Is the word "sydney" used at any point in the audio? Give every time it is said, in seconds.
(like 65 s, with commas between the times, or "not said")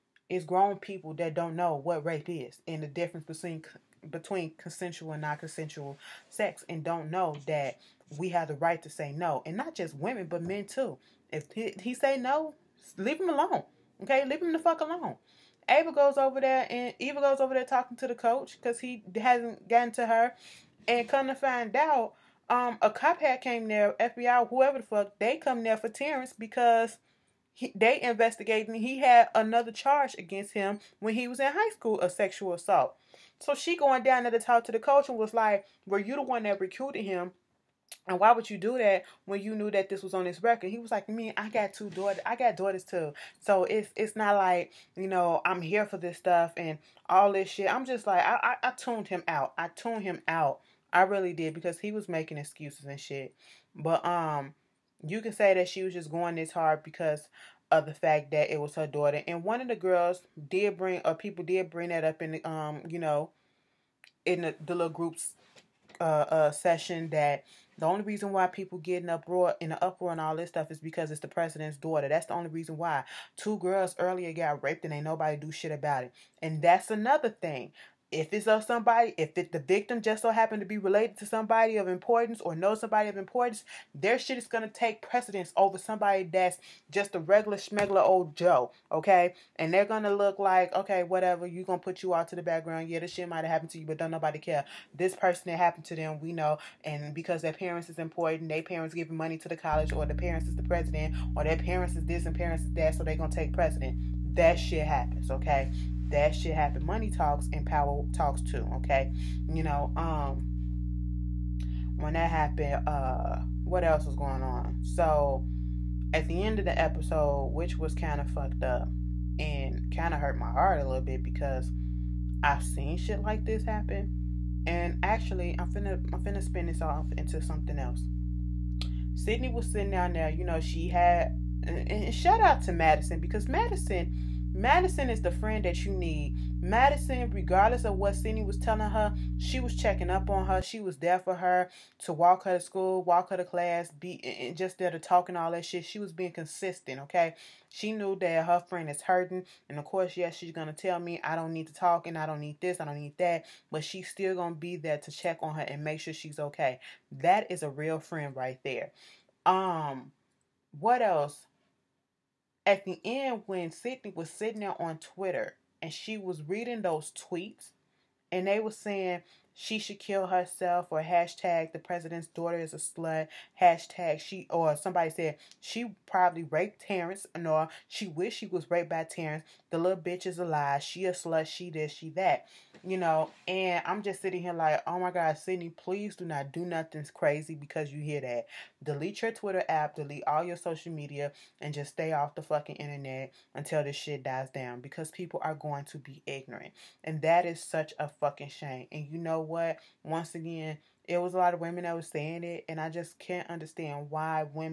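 129 s, 163 s, 185 s.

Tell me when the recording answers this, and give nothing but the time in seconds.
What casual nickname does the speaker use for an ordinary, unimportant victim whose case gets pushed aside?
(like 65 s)
87 s.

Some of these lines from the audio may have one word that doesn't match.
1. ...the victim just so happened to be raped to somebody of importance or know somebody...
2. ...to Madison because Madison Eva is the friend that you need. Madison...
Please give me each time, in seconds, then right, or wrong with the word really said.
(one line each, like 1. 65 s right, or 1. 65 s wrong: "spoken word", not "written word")
1. 79 s wrong: "related", not "raped"
2. 132 s wrong: "Madison", not "Eva".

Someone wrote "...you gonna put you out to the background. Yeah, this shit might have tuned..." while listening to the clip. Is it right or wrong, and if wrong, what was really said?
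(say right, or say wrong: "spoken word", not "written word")
wrong: "happened", not "tuned".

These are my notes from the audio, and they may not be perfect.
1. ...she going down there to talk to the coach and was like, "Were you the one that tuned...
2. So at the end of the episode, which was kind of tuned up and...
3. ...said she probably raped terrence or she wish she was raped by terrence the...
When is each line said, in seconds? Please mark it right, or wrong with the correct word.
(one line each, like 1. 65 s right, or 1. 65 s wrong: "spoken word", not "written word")
1. 33 s wrong: "recruited", not "tuned"
2. 114 s wrong: "fucked", not "tuned"
3. 175 s right.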